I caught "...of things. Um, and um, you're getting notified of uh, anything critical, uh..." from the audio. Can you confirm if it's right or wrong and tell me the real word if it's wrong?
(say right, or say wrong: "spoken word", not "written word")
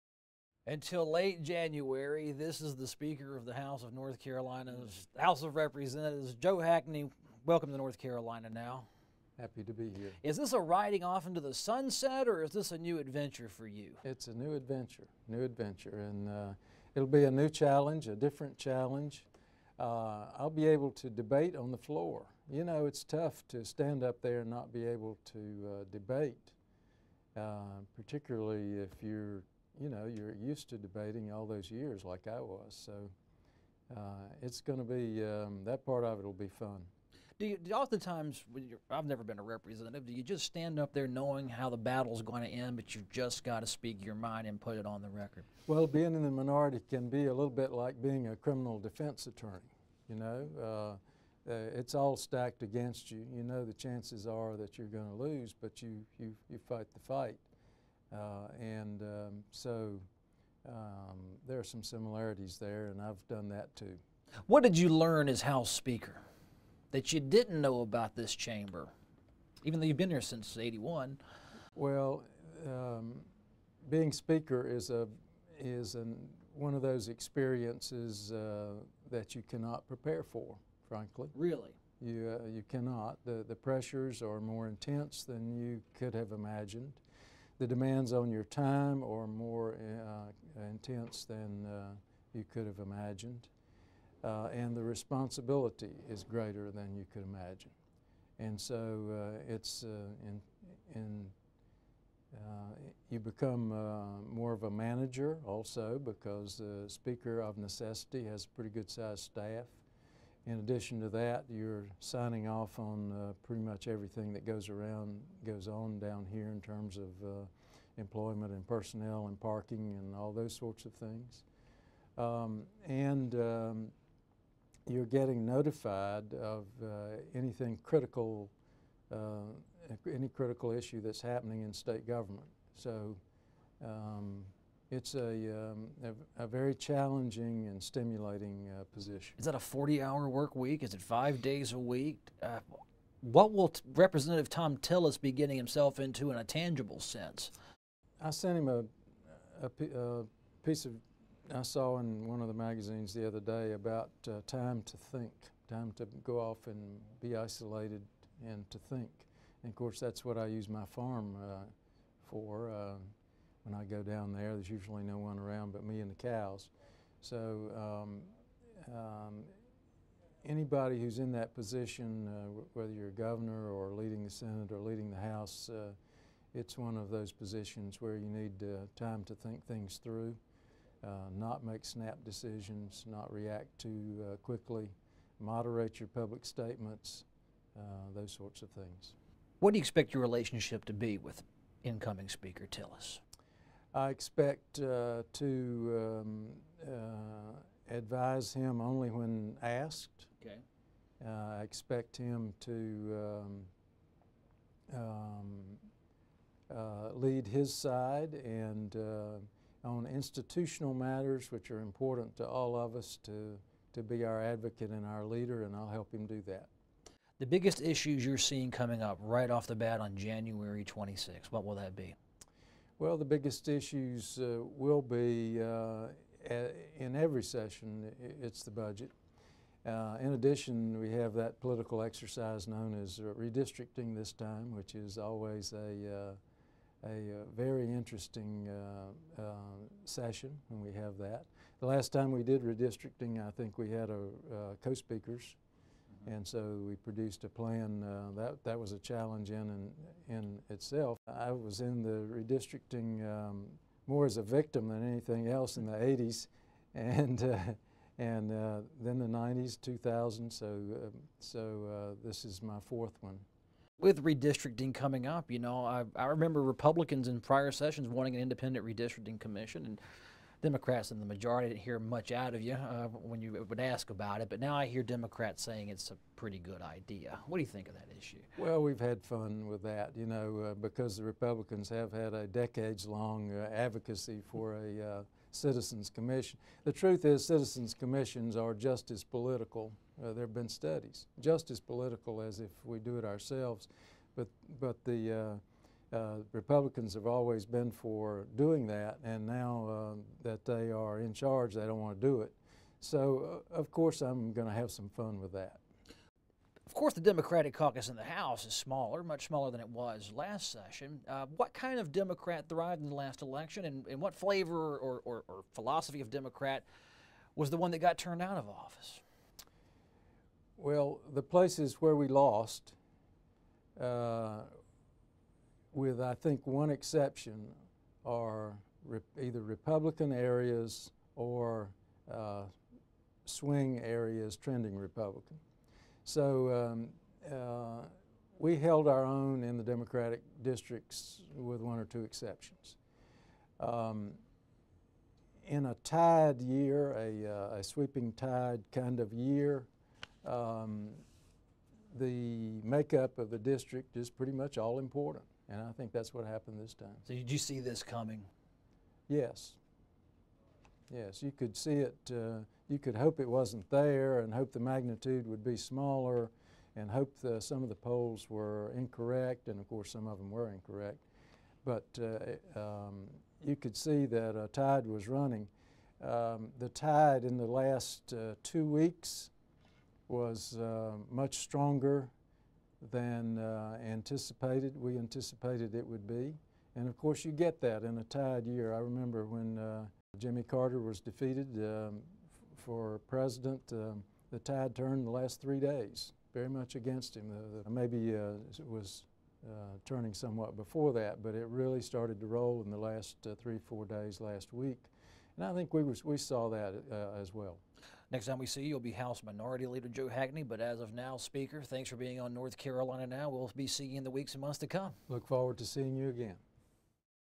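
right.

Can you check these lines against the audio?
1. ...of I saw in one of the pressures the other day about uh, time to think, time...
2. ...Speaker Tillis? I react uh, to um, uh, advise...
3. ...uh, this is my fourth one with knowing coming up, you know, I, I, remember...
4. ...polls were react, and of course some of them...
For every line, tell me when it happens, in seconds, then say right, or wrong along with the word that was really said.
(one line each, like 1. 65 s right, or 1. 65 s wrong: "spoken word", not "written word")
1. 150 s wrong: "magazines", not "pressures"
2. 192 s wrong: "expect", not "react"
3. 261 s wrong: "redistricting", not "knowing"
4. 367 s wrong: "incorrect", not "react".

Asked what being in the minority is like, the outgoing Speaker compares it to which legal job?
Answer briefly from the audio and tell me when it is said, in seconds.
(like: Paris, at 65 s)
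criminal defense attorney, at 48 s.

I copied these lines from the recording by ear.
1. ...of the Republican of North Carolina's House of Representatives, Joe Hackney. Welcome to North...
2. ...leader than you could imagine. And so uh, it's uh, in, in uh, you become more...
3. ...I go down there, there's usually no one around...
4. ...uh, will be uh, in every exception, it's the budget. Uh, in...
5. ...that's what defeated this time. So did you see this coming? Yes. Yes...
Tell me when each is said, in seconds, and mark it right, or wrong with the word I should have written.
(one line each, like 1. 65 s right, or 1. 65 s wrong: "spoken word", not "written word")
1. 3 s wrong: "House", not "Republican"
2. 96 s wrong: "greater", not "leader"
3. 163 s right
4. 224 s wrong: "session", not "exception"
5. 356 s wrong: "happened", not "defeated".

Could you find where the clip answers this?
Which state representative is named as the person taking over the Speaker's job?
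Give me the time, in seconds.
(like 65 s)
144 s.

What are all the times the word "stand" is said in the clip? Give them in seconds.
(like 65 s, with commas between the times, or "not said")
23 s, 40 s.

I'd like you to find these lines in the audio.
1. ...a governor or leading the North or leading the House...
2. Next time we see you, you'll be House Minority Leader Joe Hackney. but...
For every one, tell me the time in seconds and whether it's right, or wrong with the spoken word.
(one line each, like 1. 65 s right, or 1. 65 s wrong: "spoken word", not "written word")
1. 173 s wrong: "Senate", not "North"
2. 408 s right.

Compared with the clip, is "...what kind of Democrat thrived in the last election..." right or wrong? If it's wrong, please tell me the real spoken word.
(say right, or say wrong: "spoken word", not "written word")
right.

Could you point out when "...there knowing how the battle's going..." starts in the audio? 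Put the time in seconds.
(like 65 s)
40 s.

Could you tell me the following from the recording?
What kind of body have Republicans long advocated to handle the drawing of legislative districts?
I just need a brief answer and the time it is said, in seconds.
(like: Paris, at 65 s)
Citizens Commission, at 285 s.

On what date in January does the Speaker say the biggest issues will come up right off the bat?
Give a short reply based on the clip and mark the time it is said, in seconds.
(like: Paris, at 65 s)
January 26, at 220 s.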